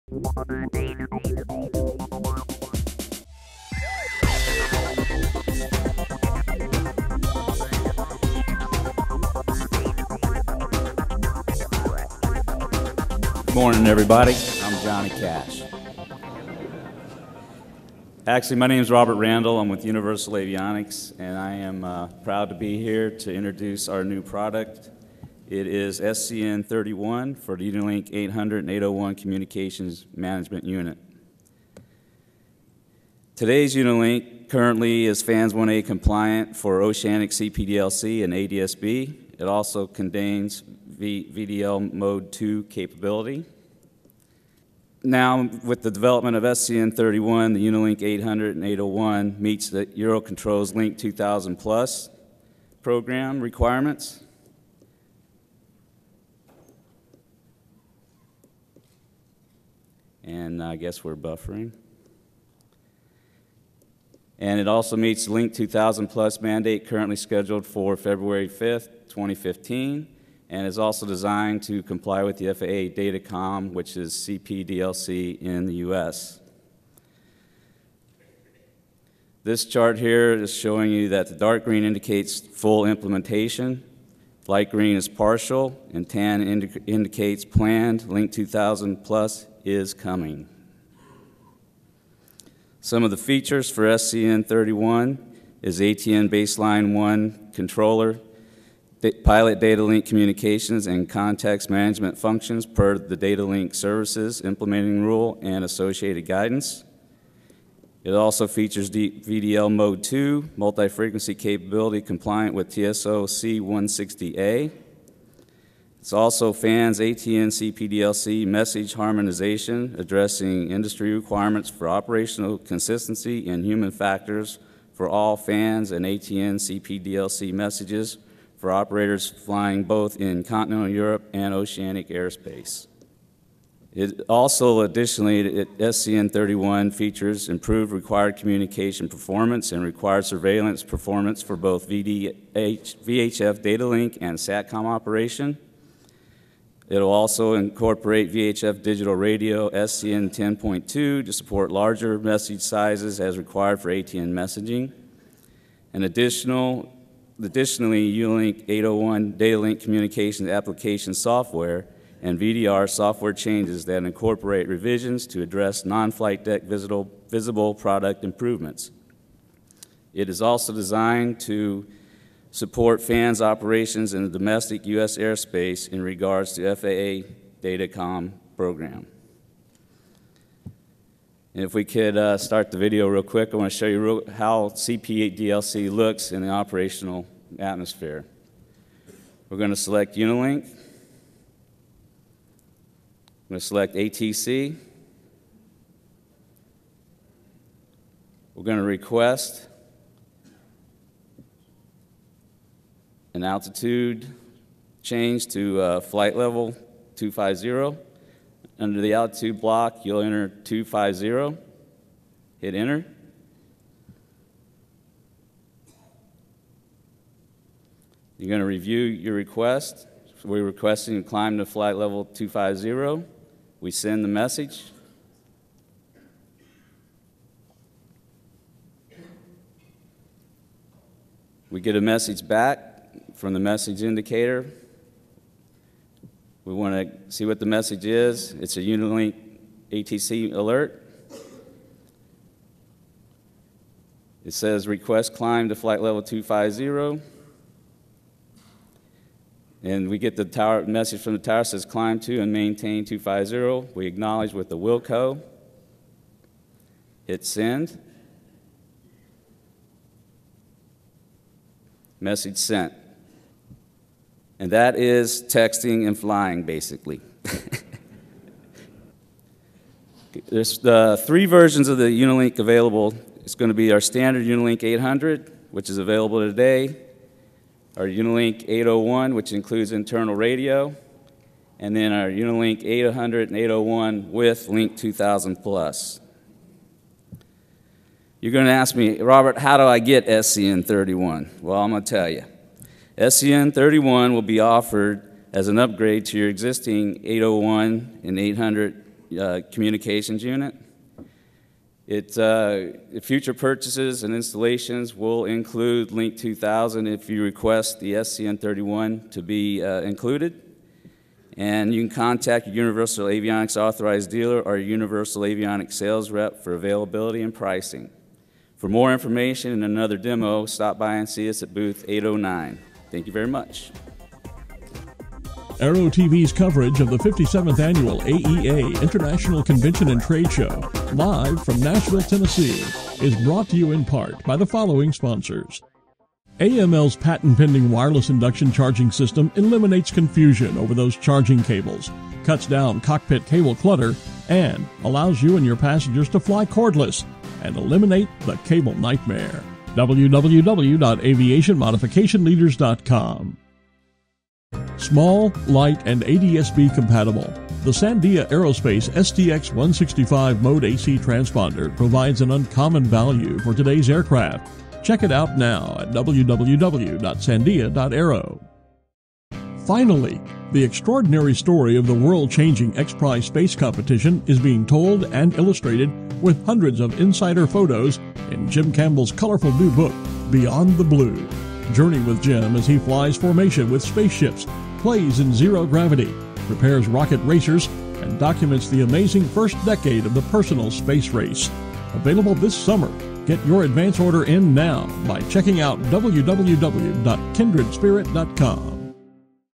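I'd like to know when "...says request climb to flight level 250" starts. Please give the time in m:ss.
4:04.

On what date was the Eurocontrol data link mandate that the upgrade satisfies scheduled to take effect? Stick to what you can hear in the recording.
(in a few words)
February 5th, 2015.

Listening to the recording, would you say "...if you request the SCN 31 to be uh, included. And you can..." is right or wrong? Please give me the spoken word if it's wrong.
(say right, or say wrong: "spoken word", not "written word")
right.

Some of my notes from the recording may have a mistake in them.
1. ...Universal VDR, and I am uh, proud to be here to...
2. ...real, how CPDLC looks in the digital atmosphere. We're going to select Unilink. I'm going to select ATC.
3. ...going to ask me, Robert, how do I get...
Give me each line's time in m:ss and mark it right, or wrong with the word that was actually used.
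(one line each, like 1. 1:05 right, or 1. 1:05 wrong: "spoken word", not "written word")
1. 0:19 wrong: "Avionics", not "VDR"
2. 3:04 wrong: "operational", not "digital"
3. 4:48 right.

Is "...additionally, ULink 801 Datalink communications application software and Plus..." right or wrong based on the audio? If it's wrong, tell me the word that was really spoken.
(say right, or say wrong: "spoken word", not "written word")
wrong: "VDR", not "Plus".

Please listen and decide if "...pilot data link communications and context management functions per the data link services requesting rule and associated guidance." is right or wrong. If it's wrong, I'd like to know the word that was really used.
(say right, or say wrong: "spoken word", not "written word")
wrong: "implementing", not "requesting".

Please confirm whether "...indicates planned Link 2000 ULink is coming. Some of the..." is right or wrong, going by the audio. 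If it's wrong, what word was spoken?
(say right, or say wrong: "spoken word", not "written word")
wrong: "Plus", not "ULink".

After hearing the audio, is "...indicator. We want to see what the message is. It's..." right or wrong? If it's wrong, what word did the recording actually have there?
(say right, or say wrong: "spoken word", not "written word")
right.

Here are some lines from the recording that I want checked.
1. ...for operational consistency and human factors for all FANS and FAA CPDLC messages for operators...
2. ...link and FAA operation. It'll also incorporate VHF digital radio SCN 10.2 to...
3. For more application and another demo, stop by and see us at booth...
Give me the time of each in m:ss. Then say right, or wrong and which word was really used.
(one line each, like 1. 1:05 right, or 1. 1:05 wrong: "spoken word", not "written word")
1. 2:01 wrong: "ATN", not "FAA"
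2. 2:23 wrong: "SATCOM", not "FAA"
3. 5:18 wrong: "information", not "application".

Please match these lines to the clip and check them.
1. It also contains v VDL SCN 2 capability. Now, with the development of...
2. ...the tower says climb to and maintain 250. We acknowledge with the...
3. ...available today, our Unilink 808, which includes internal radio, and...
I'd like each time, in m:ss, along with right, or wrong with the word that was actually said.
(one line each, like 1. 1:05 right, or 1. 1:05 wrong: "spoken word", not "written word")
1. 0:39 wrong: "Mode", not "SCN"
2. 4:11 right
3. 4:35 wrong: "801", not "808".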